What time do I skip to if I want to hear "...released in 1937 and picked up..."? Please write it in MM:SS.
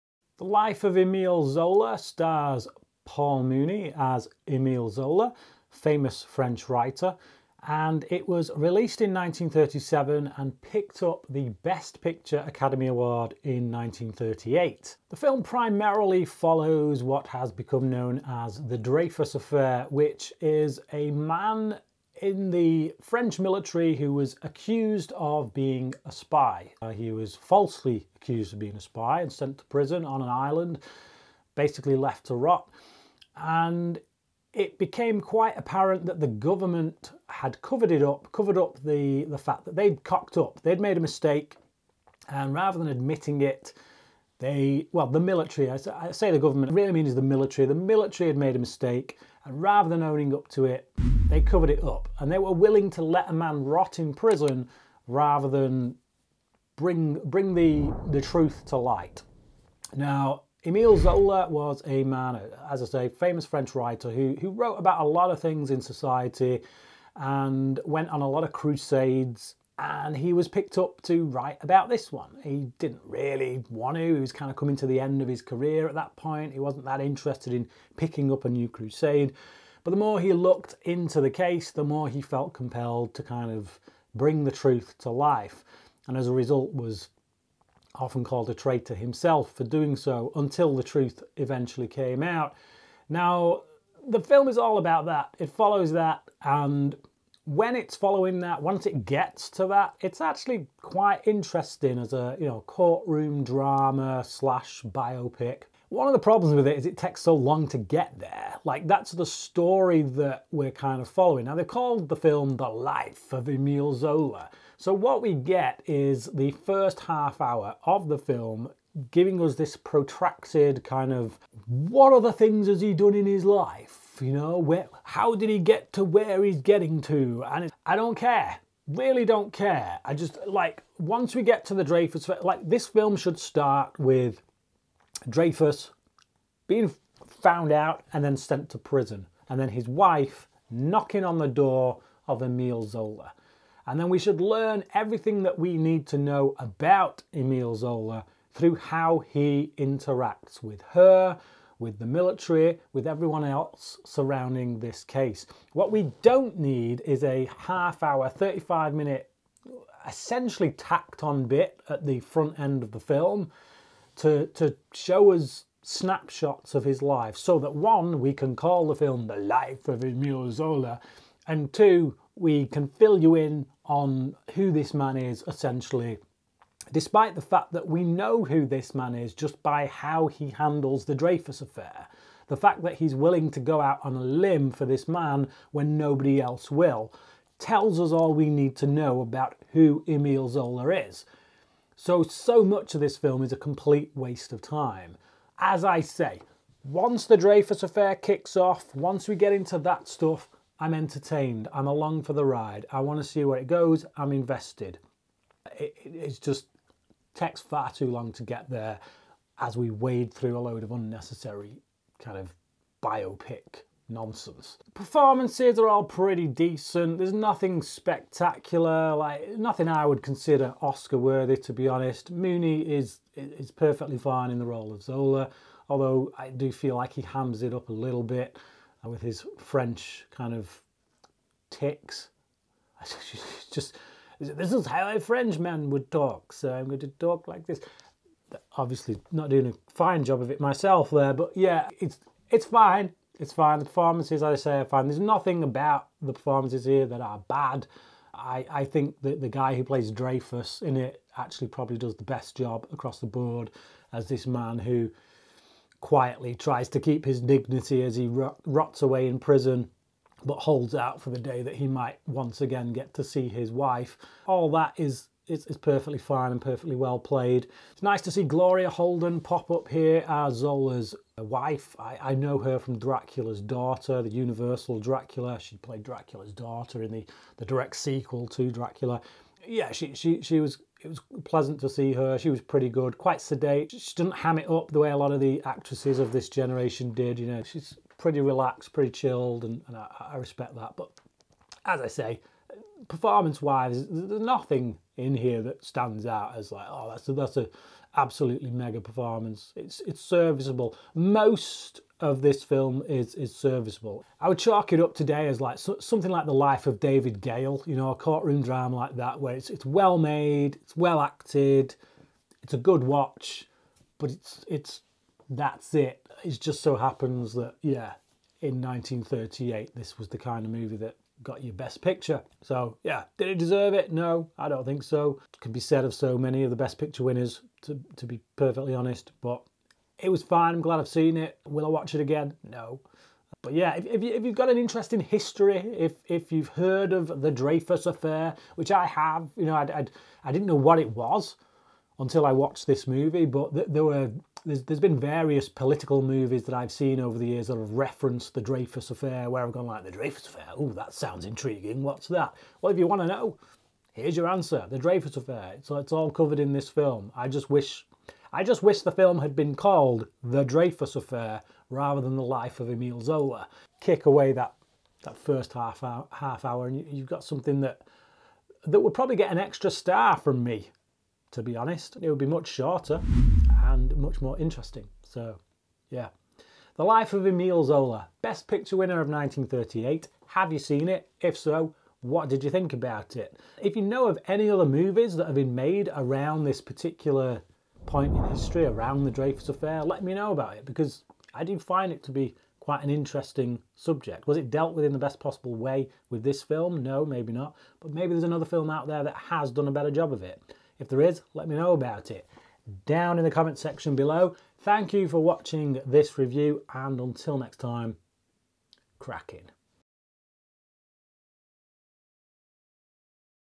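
00:08.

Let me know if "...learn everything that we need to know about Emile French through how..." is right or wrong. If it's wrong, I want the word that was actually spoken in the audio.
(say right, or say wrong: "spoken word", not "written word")
wrong: "Zola", not "French".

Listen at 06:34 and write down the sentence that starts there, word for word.
Was it dealt with in the best possible way with this film?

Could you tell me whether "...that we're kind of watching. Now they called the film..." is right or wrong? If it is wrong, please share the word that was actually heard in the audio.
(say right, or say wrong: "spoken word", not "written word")
wrong: "following", not "watching".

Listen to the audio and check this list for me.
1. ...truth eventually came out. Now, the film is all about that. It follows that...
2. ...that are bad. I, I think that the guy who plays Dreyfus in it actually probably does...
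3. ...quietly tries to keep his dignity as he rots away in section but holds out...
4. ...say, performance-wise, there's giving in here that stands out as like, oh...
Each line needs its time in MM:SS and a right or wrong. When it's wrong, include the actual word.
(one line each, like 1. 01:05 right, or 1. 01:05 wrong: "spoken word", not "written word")
1. 01:30 right
2. 04:07 right
3. 04:16 wrong: "prison", not "section"
4. 04:52 wrong: "nothing", not "giving".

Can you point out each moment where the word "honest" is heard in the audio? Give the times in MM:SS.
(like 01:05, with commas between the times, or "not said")
03:41, 05:28, 06:11.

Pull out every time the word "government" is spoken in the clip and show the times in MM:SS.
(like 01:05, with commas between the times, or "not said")
00:36, 00:46.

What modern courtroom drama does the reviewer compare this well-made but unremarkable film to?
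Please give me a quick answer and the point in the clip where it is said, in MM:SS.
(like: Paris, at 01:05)
The Life of David Gale, at 05:06.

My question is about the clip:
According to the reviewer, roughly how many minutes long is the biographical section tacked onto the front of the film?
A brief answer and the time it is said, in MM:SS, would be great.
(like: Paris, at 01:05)
35, at 02:38.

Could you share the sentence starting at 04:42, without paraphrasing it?
She was pretty good, quite sedate.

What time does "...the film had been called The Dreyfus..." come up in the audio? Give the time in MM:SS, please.
05:59.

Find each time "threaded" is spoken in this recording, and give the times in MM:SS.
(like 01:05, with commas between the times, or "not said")
not said.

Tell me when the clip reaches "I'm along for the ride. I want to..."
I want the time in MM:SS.
03:21.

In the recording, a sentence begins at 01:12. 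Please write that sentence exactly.
He didn't really want to, he was kind of coming to the end of his career at that point.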